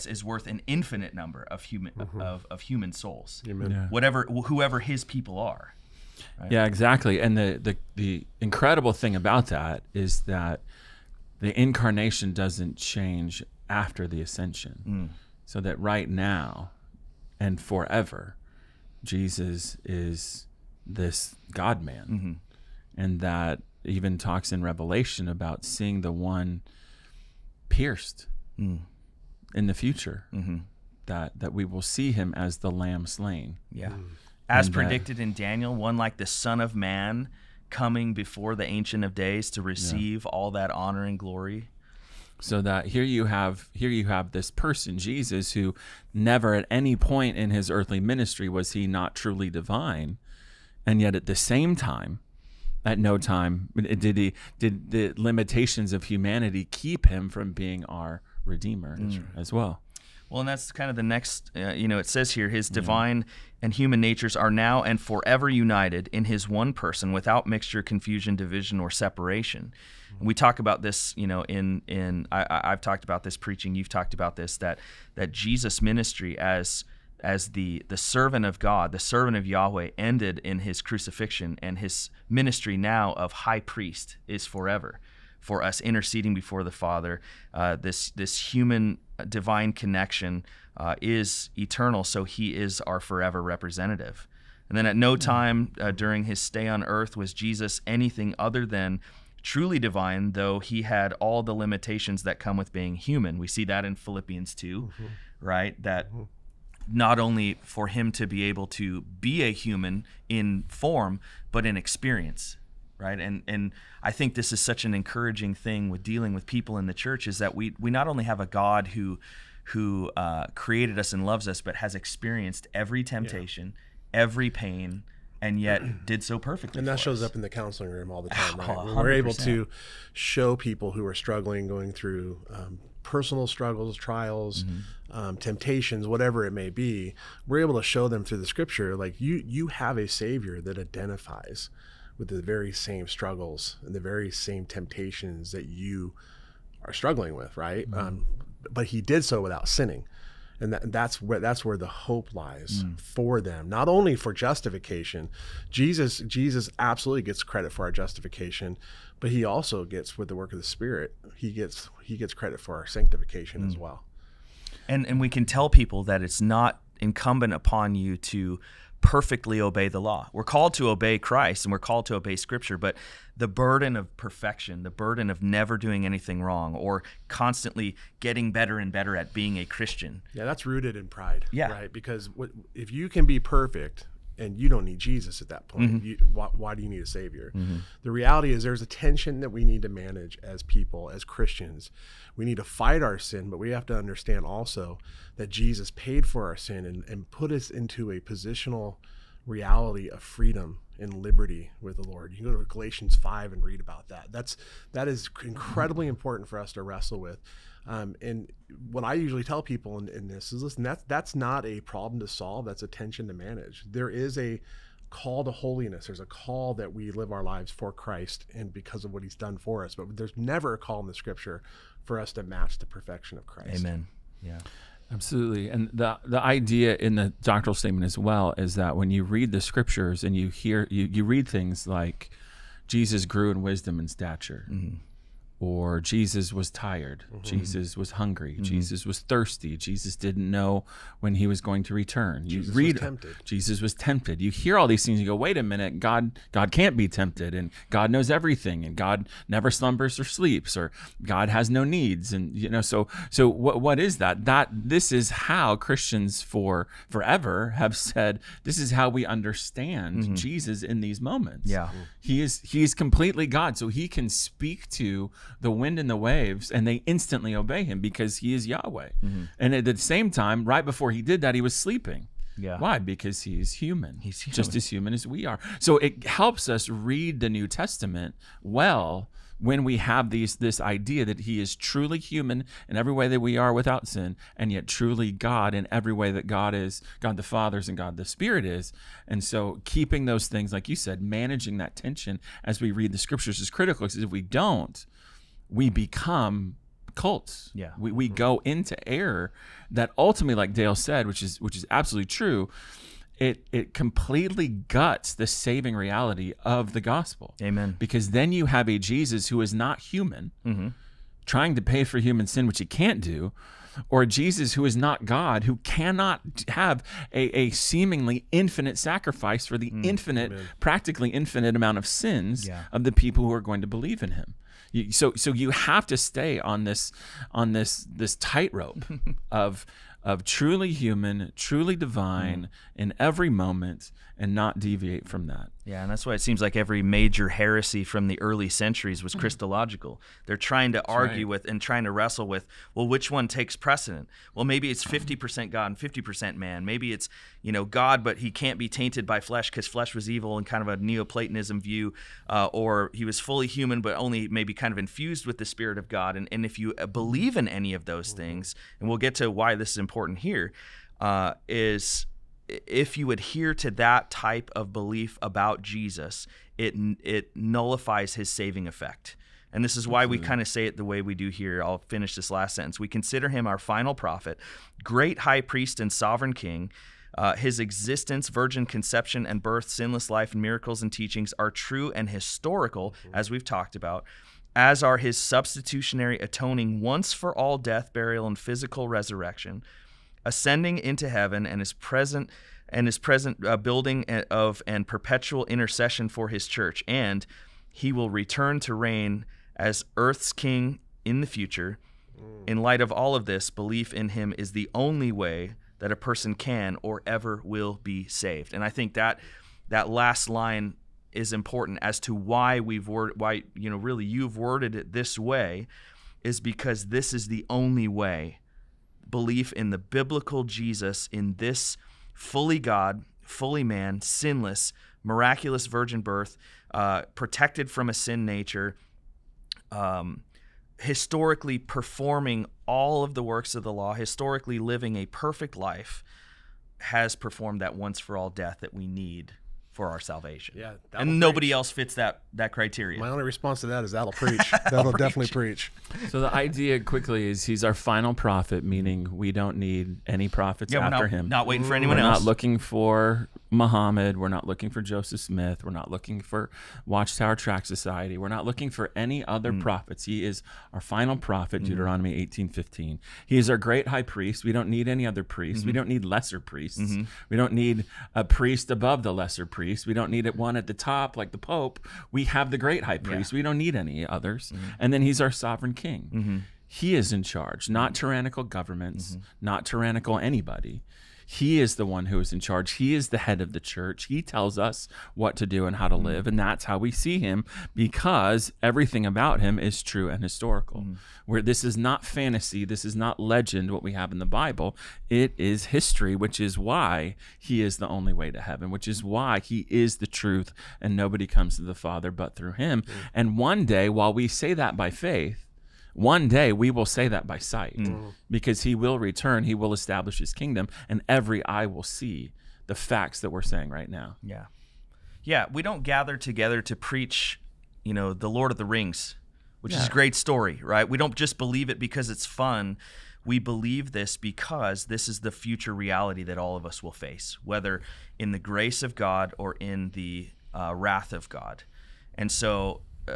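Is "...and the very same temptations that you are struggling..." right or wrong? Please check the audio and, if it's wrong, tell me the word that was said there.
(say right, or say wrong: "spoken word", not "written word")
right.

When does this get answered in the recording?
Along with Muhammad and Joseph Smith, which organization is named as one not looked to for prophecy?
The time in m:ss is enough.
7:37.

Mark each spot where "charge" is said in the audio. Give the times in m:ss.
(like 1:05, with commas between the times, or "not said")
7:57, 8:02.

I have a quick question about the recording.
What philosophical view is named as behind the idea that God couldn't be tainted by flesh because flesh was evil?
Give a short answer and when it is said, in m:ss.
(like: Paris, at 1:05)
Neoplatonism, at 5:51.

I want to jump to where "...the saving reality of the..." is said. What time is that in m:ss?
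5:05.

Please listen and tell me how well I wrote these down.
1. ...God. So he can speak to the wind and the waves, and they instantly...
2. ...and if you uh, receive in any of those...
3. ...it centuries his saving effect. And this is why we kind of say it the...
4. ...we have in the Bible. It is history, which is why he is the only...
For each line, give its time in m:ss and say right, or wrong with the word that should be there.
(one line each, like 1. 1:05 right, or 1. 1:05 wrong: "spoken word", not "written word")
1. 4:23 right
2. 5:56 wrong: "believe", not "receive"
3. 6:07 wrong: "nullifies", not "centuries"
4. 8:14 right.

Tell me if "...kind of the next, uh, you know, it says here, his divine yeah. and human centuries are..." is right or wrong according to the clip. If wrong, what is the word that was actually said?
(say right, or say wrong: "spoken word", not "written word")
wrong: "natures", not "centuries".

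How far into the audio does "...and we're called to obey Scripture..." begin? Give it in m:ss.
2:51.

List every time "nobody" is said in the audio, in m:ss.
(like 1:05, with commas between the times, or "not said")
7:21, 8:21.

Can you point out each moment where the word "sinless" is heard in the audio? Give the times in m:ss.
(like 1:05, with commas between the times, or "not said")
6:19, 7:04.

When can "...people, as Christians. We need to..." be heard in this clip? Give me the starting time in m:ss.
3:10.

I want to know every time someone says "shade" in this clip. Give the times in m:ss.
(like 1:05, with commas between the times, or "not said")
not said.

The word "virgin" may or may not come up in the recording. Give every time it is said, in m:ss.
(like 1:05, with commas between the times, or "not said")
6:18, 7:05.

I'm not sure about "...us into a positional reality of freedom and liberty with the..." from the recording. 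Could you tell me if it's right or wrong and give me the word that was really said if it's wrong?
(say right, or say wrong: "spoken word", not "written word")
right.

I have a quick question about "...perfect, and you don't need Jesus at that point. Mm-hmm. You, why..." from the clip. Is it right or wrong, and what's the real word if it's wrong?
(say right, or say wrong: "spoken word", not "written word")
right.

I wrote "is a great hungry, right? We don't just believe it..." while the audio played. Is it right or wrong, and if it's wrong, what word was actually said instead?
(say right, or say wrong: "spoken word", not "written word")
wrong: "story", not "hungry".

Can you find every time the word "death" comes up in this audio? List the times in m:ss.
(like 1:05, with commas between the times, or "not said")
6:27, 7:18.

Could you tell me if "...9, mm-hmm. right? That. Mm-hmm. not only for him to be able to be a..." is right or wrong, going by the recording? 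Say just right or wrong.
wrong.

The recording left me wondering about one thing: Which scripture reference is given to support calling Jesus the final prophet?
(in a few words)
Deuteronomy 18:15.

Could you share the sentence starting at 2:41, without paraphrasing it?
He gets he gets credit for our sanctification mm.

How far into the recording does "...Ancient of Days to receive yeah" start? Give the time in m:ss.
0:38.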